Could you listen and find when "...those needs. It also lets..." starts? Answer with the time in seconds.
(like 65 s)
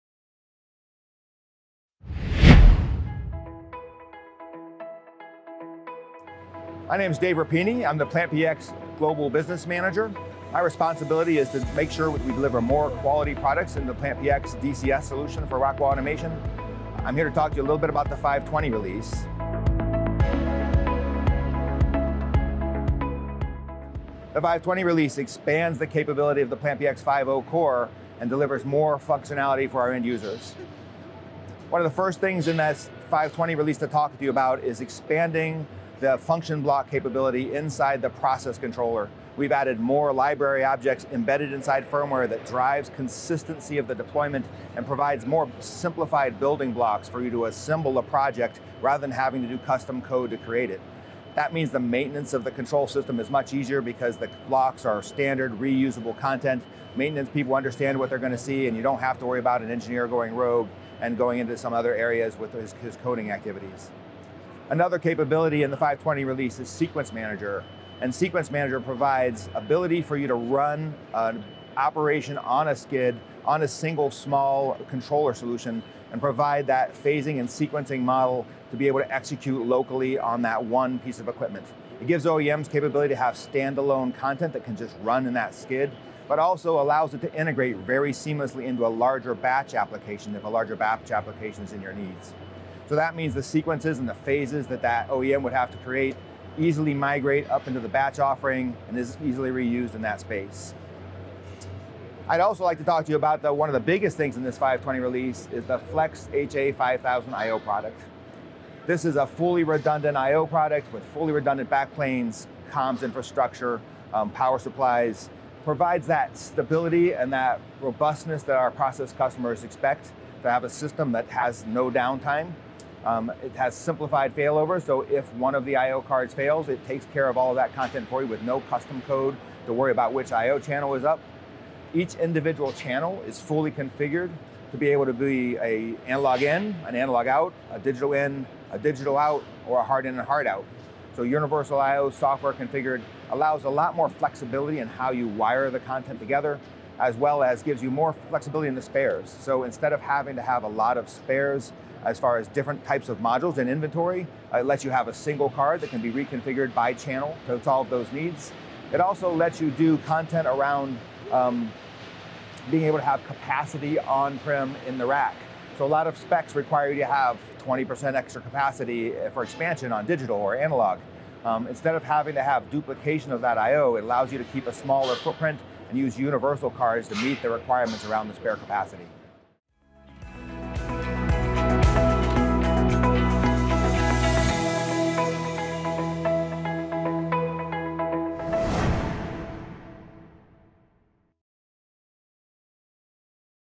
157 s.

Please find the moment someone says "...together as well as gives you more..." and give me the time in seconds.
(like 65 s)
146 s.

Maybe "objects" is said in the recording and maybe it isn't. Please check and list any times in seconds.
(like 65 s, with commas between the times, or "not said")
40 s.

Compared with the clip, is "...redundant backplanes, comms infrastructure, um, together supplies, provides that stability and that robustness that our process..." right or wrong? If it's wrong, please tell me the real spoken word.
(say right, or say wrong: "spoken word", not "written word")
wrong: "power", not "together".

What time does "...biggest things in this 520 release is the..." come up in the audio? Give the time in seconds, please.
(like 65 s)
103 s.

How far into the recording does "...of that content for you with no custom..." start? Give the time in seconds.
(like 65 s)
127 s.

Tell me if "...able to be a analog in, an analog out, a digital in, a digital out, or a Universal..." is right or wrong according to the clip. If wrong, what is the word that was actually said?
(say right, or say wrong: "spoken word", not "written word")
wrong: "HART", not "Universal".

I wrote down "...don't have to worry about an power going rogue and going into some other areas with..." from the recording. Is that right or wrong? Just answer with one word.
wrong.